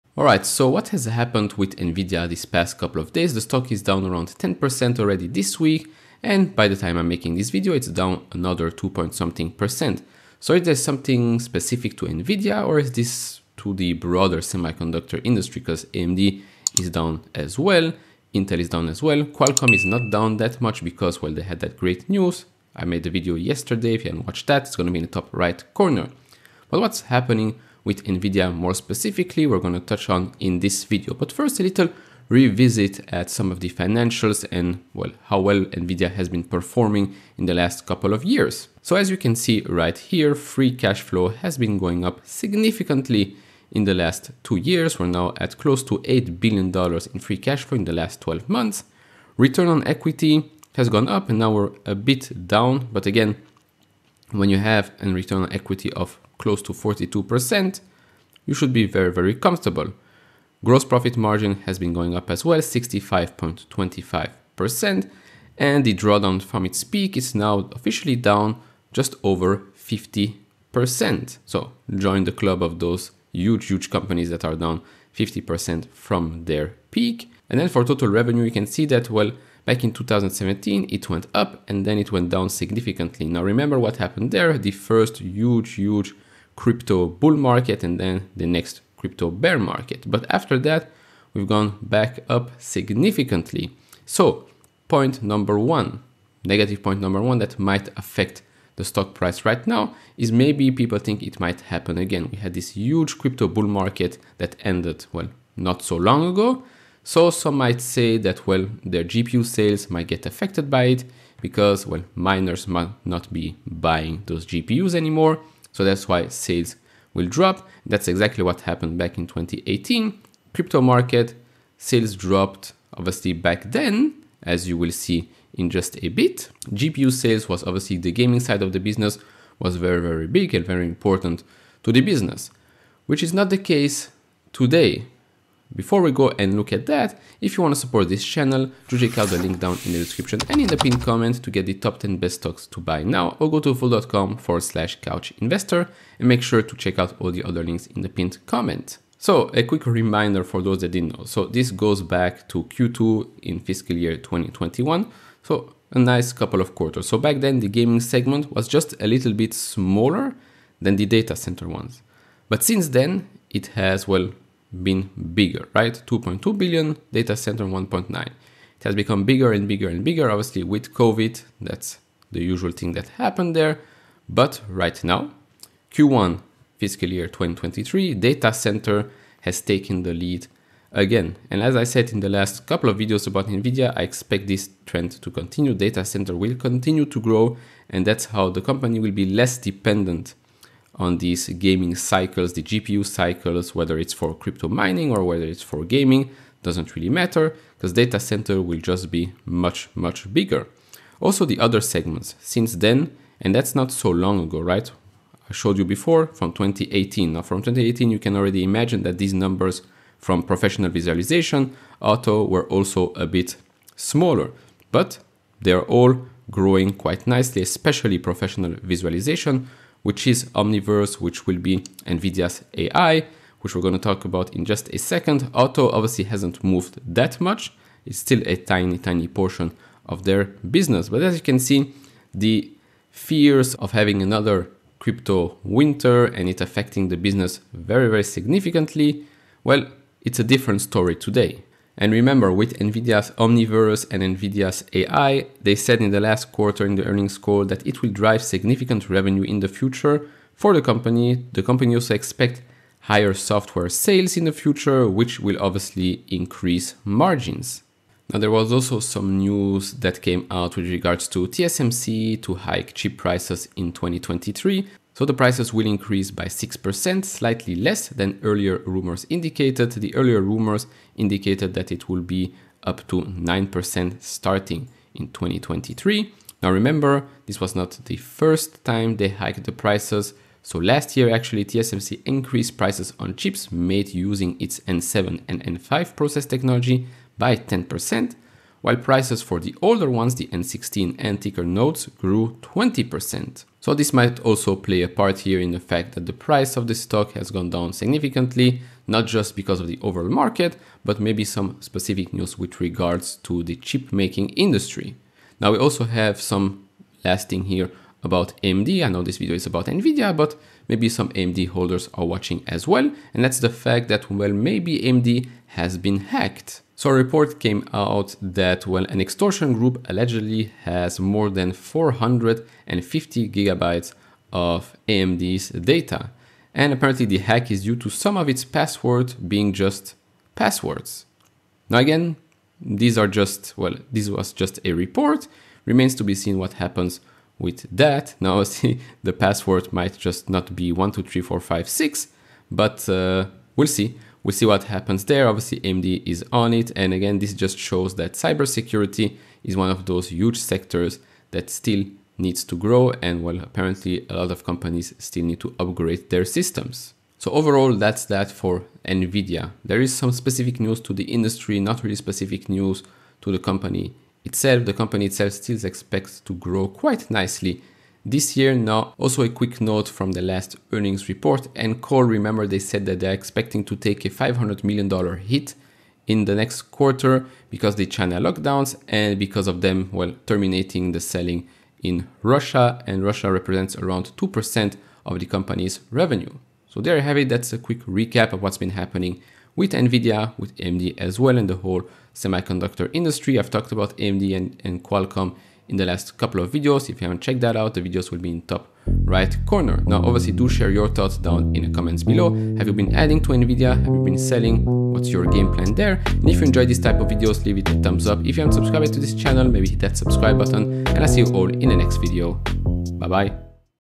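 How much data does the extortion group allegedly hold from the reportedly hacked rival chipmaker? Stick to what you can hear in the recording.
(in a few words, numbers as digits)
450 gigabytes.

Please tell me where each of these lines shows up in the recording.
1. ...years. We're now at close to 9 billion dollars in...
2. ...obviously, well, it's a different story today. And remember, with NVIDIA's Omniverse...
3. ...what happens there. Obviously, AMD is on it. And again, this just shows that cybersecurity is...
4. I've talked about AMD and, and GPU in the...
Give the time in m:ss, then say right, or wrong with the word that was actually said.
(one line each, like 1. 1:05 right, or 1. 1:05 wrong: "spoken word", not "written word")
1. 0:44 wrong: "8", not "9"
2. 3:58 wrong: "significantly", not "obviously"
3. 5:44 right
4. 6:33 wrong: "Qualcomm", not "GPU".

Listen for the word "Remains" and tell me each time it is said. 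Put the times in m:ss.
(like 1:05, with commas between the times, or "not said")
5:35.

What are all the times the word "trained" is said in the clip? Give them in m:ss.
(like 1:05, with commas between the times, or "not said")
not said.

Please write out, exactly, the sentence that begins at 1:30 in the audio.
But after that, we've gone back up significantly.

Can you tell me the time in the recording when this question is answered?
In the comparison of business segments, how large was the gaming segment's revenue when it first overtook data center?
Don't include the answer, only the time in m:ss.
2:46.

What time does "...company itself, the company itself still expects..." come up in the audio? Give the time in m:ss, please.
6:03.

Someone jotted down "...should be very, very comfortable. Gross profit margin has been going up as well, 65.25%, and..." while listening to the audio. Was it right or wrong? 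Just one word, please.
right.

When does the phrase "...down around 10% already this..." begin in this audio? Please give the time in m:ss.
0:03.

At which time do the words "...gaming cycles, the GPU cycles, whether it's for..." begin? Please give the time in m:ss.
3:11.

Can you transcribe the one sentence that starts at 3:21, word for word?
Also the other segments since then, and that's not so long ago, right?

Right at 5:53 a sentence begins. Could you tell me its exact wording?
And well, apparently a lot of companies still need to upgrade their systems.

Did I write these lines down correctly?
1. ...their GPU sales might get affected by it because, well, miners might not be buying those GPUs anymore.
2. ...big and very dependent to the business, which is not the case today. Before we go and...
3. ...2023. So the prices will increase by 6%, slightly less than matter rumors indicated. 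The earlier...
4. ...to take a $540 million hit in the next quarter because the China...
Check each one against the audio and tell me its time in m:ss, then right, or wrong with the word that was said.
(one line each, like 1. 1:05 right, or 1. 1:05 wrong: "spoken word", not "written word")
1. 1:48 right
2. 2:10 wrong: "important", not "dependent"
3. 4:23 wrong: "earlier", not "matter"
4. 6:13 wrong: "500", not "540".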